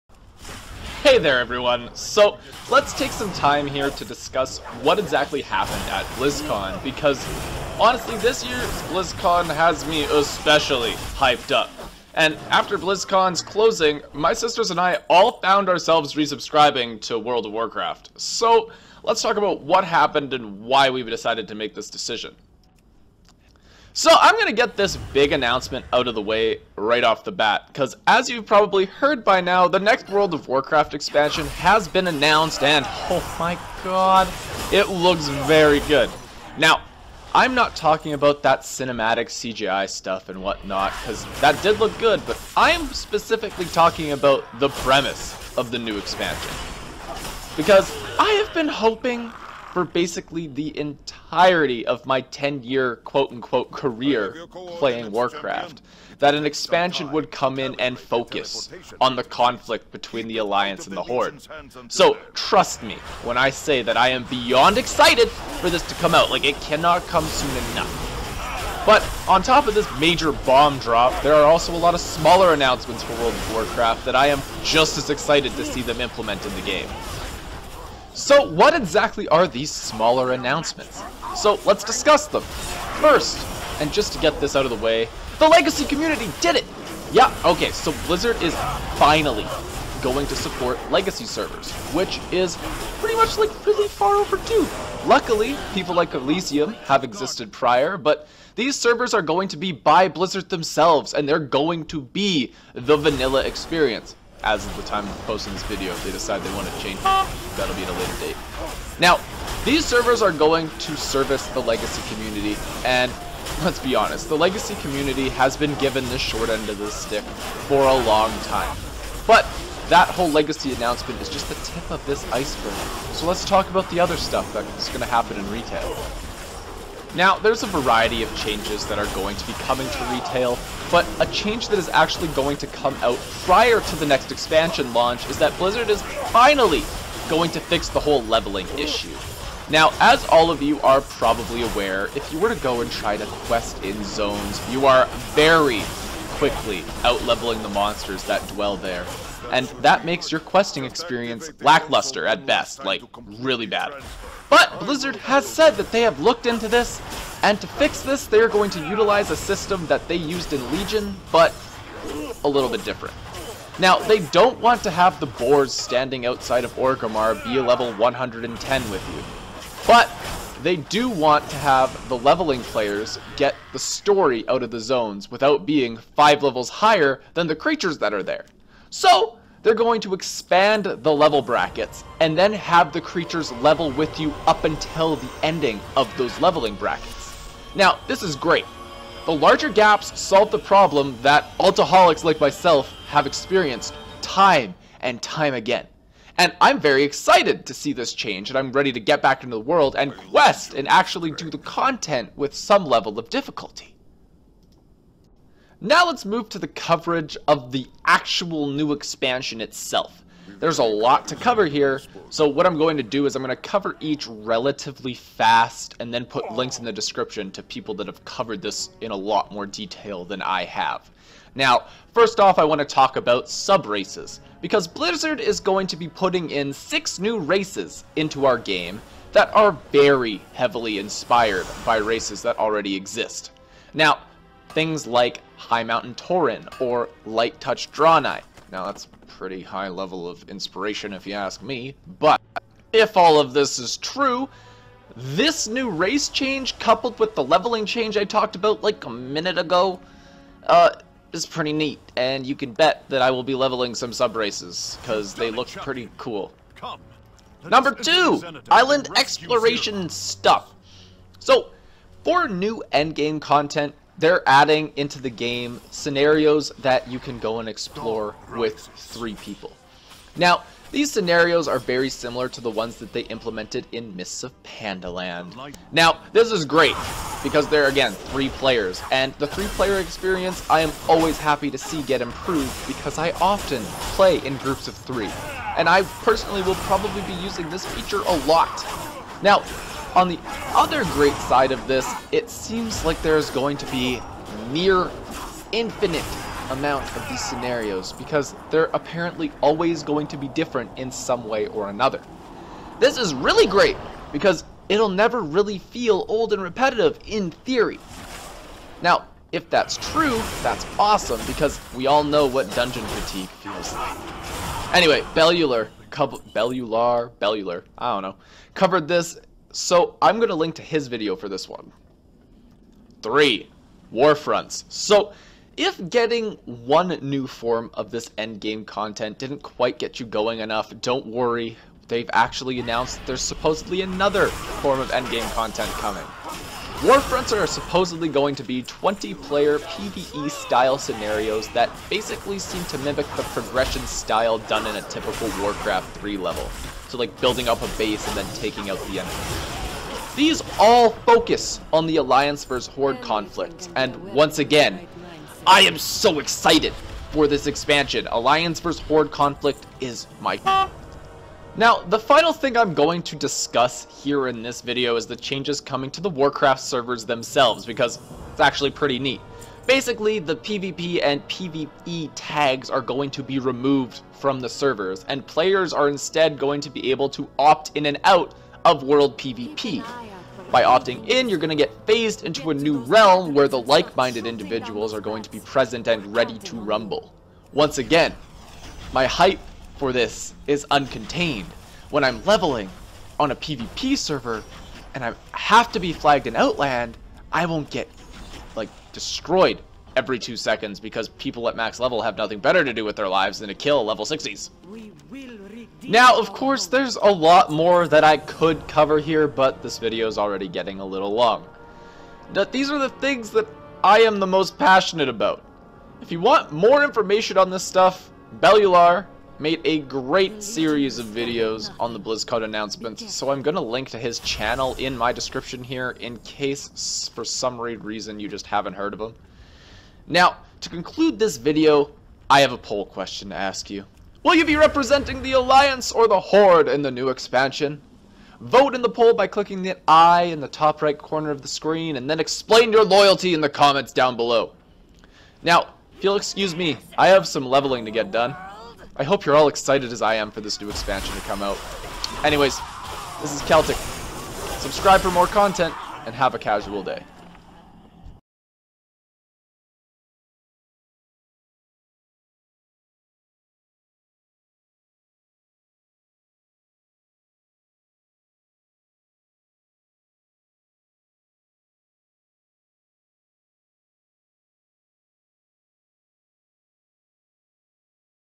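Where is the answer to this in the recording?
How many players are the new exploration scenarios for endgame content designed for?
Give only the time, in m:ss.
4:28.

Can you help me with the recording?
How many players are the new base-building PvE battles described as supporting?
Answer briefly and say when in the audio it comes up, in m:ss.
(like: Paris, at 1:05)
20, at 5:38.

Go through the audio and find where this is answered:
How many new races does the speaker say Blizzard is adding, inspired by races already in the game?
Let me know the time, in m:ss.
3:46.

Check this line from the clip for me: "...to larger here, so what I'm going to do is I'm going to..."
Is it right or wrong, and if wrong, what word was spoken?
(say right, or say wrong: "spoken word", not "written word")
wrong: "cover", not "larger".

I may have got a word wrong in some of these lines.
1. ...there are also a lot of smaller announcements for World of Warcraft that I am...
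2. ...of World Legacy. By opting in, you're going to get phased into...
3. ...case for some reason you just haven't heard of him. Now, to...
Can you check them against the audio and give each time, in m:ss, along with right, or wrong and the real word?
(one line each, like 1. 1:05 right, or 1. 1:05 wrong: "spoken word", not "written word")
1. 1:11 right
2. 6:18 wrong: "PvP", not "Legacy"
3. 7:06 right.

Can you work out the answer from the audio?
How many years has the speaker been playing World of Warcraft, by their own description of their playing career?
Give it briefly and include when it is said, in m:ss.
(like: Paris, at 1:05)
10, at 0:52.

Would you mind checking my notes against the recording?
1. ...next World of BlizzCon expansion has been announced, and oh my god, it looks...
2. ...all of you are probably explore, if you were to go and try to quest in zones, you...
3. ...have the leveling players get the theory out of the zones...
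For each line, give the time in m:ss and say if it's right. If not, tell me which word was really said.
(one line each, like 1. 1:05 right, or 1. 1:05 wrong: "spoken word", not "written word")
1. 0:29 wrong: "Warcraft", not "BlizzCon"
2. 2:20 wrong: "aware", not "explore"
3. 2:51 wrong: "story", not "theory".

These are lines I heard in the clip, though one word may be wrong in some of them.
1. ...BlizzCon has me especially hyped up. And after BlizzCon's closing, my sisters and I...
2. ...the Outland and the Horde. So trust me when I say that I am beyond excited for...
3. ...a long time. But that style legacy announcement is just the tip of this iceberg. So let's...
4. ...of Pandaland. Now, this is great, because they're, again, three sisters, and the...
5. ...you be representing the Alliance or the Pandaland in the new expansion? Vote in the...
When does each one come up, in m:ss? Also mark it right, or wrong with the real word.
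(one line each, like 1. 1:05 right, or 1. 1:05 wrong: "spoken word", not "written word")
1. 0:08 right
2. 1:00 wrong: "Alliance", not "Outland"
3. 1:57 wrong: "whole", not "style"
4. 4:34 wrong: "players", not "sisters"
5. 7:14 wrong: "Horde", not "Pandaland".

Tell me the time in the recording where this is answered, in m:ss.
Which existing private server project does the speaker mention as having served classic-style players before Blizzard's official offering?
1:36.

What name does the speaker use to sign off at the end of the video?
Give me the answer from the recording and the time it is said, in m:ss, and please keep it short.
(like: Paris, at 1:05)
Keltick, at 7:33.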